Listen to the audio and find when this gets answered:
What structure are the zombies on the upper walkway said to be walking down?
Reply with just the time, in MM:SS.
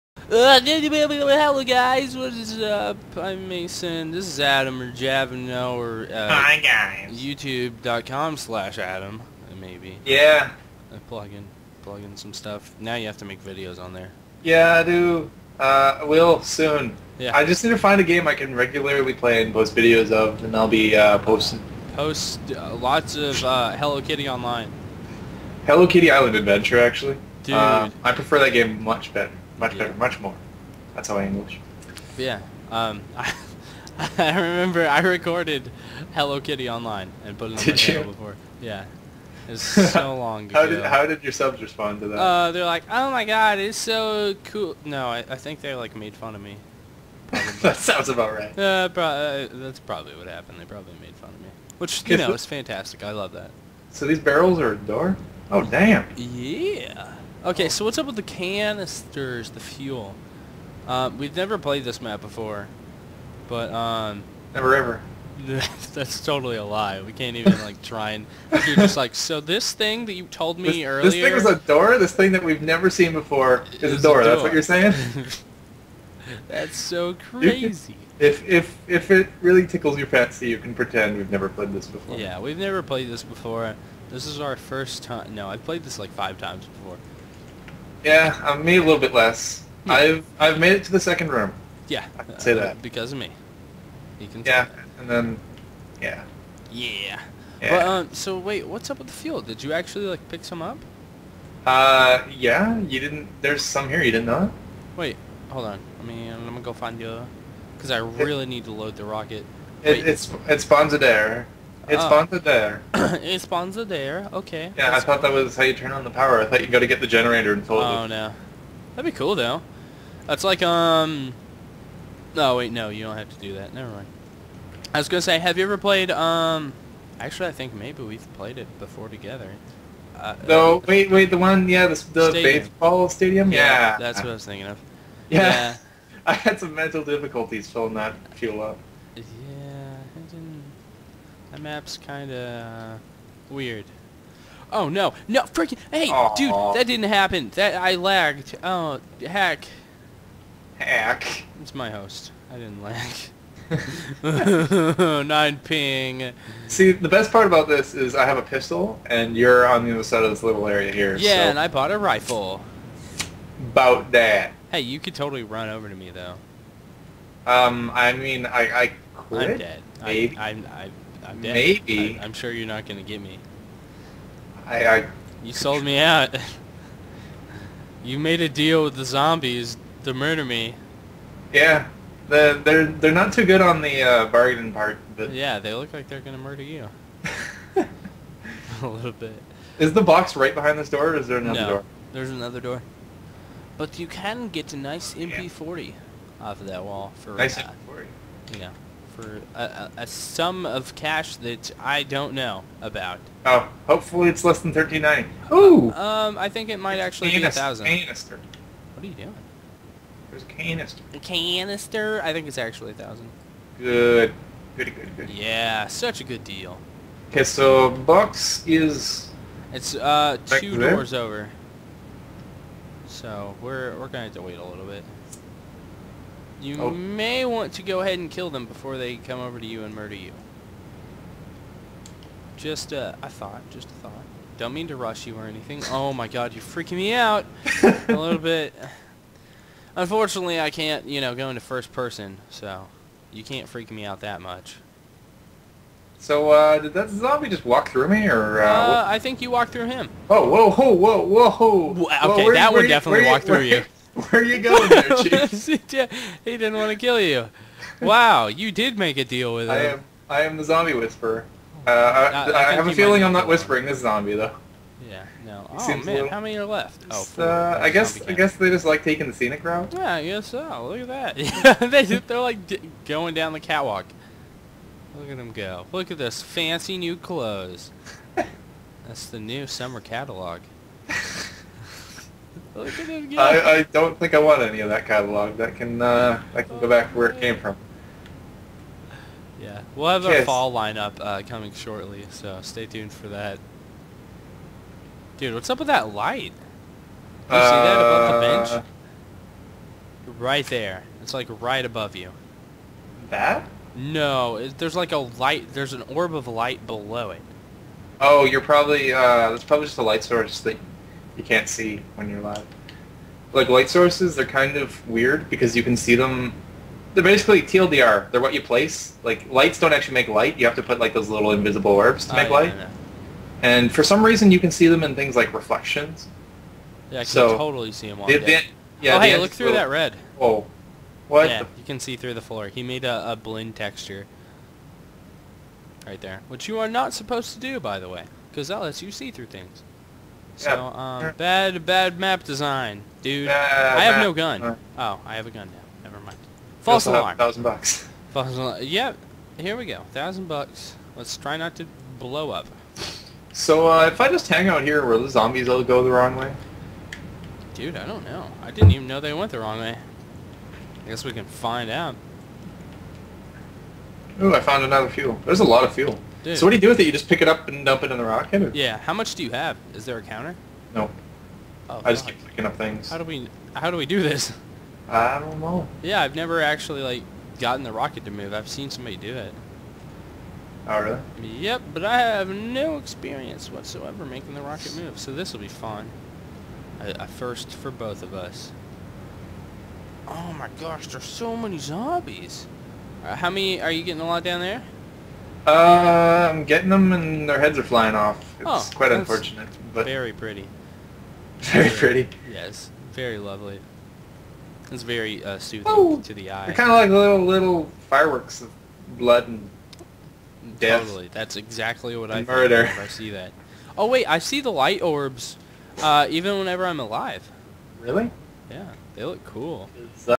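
04:33.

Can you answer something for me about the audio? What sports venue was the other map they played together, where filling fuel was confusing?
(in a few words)
baseball stadium.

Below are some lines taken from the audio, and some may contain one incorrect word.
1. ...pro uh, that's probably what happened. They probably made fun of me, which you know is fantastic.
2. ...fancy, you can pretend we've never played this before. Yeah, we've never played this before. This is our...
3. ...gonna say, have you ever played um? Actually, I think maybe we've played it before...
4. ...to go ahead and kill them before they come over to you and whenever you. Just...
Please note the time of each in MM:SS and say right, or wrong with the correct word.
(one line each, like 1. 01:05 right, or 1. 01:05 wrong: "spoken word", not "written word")
1. 00:48 right
2. 01:20 right
3. 02:05 right
4. 03:47 wrong: "murder", not "whenever".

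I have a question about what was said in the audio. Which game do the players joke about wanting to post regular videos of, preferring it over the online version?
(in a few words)
Hello Kitty Island Adventure.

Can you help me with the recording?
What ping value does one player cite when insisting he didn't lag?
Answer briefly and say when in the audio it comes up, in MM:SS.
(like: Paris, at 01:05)
9, at 02:35.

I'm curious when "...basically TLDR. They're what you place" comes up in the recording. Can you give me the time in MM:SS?
05:17.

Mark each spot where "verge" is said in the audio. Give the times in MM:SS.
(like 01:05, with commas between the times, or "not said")
not said.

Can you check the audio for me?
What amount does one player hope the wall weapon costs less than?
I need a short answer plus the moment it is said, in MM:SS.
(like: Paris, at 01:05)
1390, at 03:24.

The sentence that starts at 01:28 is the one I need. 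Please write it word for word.
Yeah, I'm um, me a little bit less.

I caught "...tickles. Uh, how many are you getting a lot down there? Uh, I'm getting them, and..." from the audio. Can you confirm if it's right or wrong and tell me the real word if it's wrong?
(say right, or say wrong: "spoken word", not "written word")
wrong: "zombies", not "tickles".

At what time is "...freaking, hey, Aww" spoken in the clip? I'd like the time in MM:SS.
02:25.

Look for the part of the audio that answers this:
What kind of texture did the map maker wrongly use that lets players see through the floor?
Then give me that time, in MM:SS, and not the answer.
05:33.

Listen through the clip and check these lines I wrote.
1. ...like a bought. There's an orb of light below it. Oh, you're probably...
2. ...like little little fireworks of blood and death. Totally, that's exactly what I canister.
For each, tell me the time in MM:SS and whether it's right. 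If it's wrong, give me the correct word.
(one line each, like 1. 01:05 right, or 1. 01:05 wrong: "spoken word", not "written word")
1. 05:04 wrong: "light", not "bought"
2. 06:46 wrong: "murder", not "canister".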